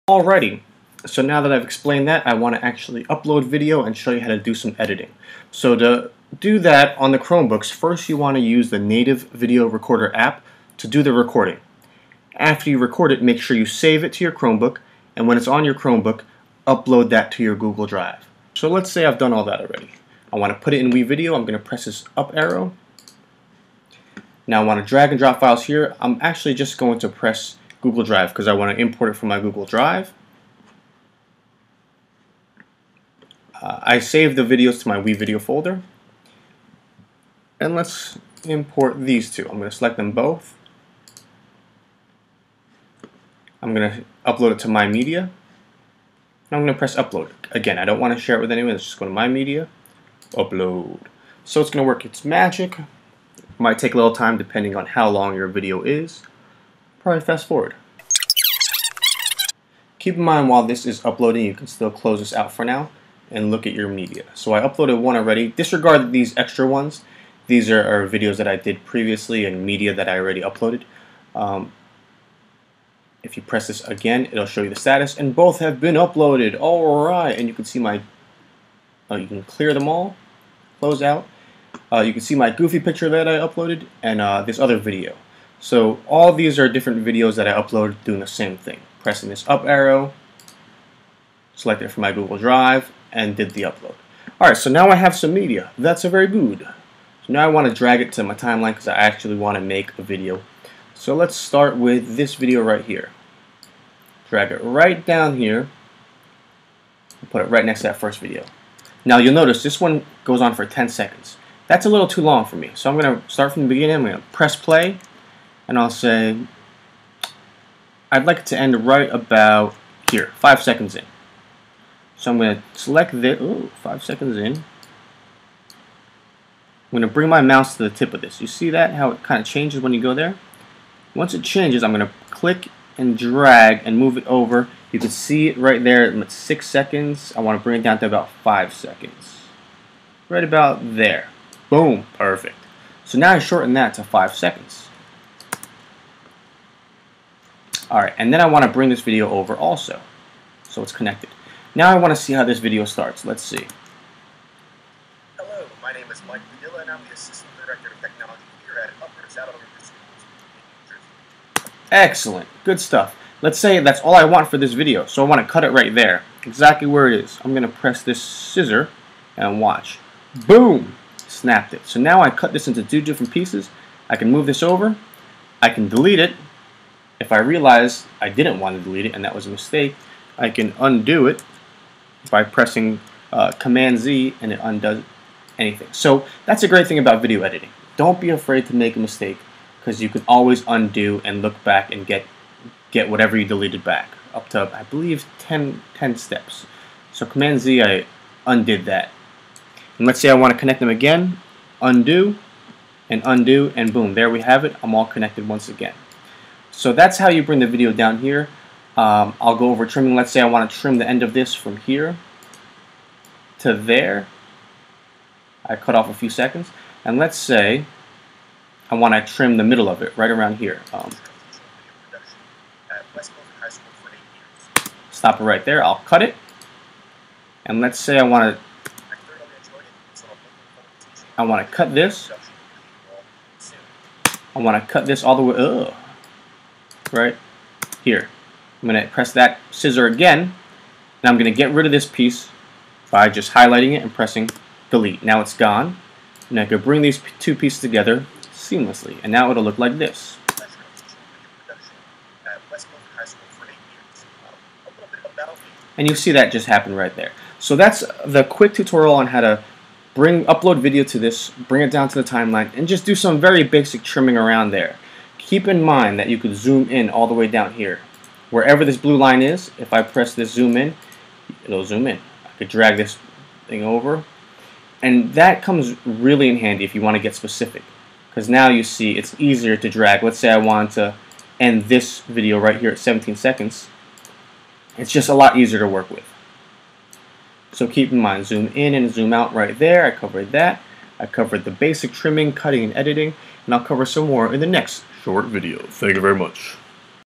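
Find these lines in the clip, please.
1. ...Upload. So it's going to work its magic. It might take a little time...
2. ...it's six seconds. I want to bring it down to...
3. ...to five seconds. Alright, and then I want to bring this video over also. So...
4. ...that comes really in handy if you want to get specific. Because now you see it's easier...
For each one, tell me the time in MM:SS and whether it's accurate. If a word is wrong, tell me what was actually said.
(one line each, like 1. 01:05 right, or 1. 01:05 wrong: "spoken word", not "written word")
1. 00:50 right
2. 02:16 right
3. 02:23 right
4. 04:35 right.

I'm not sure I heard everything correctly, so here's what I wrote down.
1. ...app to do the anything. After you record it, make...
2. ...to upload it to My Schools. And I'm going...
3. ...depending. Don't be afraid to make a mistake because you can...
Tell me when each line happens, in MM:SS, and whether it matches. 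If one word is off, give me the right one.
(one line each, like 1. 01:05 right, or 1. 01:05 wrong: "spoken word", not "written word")
1. 00:10 wrong: "recording", not "anything"
2. 00:43 wrong: "Media", not "Schools"
3. 03:07 wrong: "editing", not "depending".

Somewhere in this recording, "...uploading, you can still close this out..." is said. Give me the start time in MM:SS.
01:01.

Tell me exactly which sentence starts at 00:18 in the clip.
So let's say I've done all that already.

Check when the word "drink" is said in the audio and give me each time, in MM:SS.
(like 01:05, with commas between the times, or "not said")
not said.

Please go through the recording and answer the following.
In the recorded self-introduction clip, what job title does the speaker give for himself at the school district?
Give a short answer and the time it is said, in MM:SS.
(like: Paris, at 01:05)
Assistant Director of Technology, at 02:37.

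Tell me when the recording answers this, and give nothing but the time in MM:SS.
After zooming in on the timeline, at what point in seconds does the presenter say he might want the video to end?
04:42.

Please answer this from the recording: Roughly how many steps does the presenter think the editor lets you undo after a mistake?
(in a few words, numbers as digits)
10.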